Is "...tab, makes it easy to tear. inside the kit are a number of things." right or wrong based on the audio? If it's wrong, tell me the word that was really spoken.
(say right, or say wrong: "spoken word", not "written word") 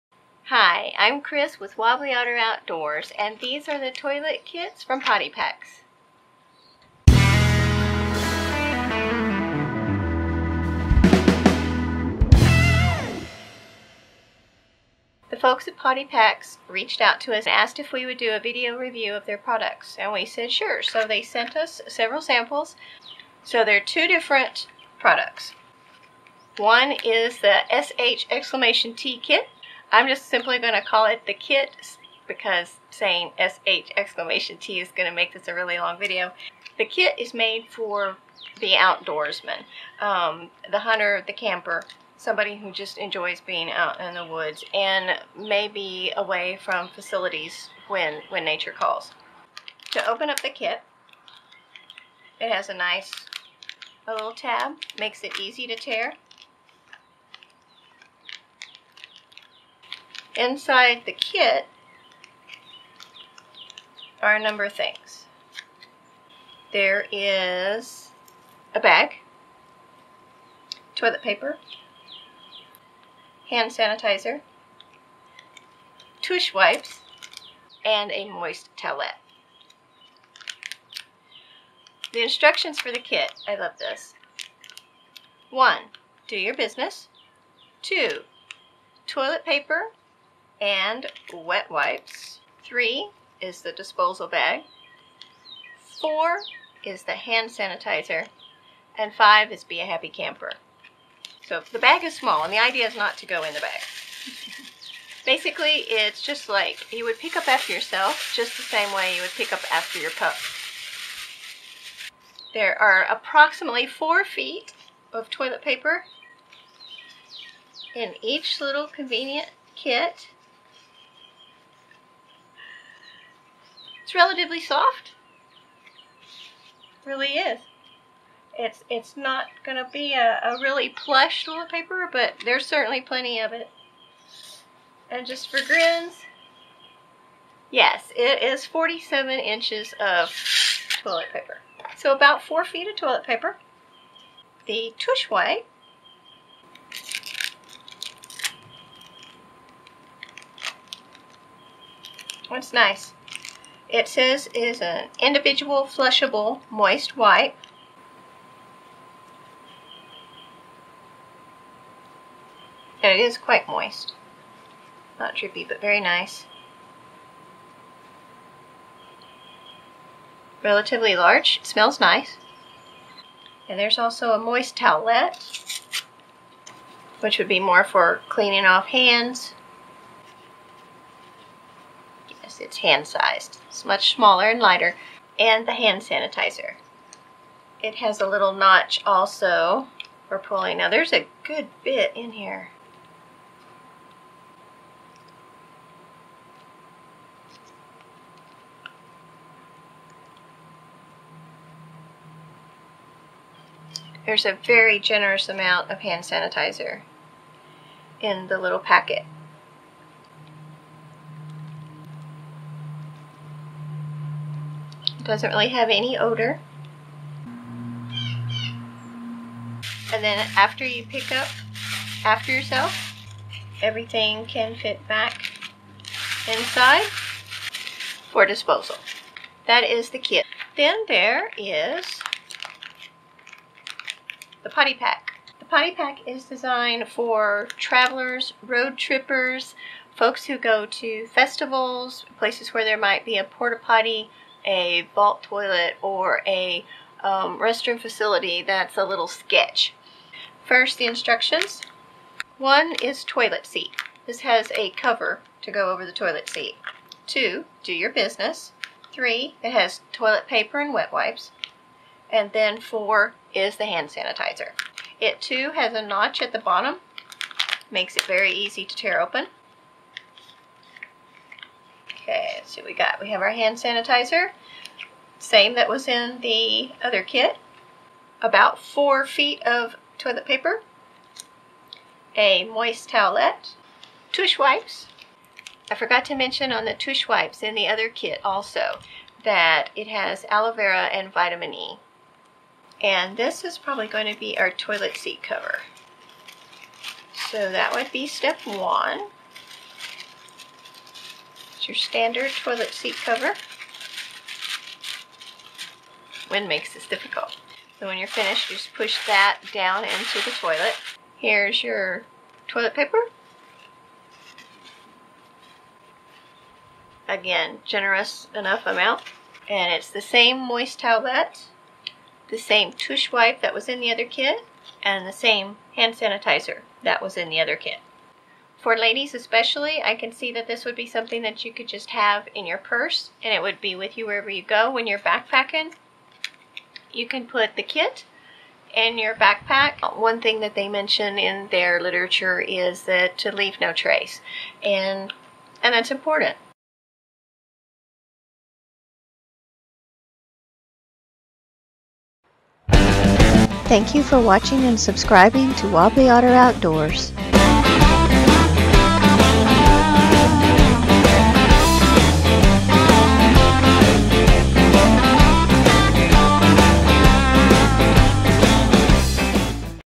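right.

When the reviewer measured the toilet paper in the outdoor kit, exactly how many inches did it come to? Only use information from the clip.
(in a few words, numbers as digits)
47.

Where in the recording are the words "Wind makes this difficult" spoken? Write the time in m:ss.
5:06.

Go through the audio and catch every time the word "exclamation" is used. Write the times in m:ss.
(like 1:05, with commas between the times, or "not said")
0:28, 0:33.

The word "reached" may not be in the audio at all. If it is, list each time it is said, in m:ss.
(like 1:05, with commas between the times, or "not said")
0:16.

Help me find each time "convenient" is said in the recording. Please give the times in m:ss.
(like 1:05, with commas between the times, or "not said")
1:58.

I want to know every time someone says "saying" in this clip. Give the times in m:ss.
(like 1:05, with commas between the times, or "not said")
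0:32.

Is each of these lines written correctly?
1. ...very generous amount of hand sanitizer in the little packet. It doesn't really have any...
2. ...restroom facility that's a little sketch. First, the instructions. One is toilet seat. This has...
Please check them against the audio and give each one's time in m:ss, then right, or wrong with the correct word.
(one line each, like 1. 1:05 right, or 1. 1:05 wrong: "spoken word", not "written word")
1. 3:24 right
2. 4:07 right.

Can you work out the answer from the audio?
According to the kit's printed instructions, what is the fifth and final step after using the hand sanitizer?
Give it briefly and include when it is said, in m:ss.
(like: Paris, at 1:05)
Be a happy camper, at 1:39.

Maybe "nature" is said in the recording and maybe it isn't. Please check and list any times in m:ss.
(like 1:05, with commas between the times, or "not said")
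0:48.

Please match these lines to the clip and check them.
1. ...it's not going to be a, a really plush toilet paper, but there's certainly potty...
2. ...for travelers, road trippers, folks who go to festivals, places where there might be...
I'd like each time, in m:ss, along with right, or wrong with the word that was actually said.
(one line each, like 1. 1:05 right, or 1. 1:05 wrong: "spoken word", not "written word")
1. 2:08 wrong: "plenty", not "potty"
2. 3:57 right.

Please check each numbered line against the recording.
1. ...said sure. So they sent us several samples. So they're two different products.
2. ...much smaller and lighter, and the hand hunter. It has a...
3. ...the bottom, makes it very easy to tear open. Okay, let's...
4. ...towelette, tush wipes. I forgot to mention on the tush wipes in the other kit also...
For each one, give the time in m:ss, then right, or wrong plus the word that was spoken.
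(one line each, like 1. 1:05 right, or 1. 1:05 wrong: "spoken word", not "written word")
1. 0:20 right
2. 3:03 wrong: "sanitizer", not "hunter"
3. 4:26 right
4. 4:43 right.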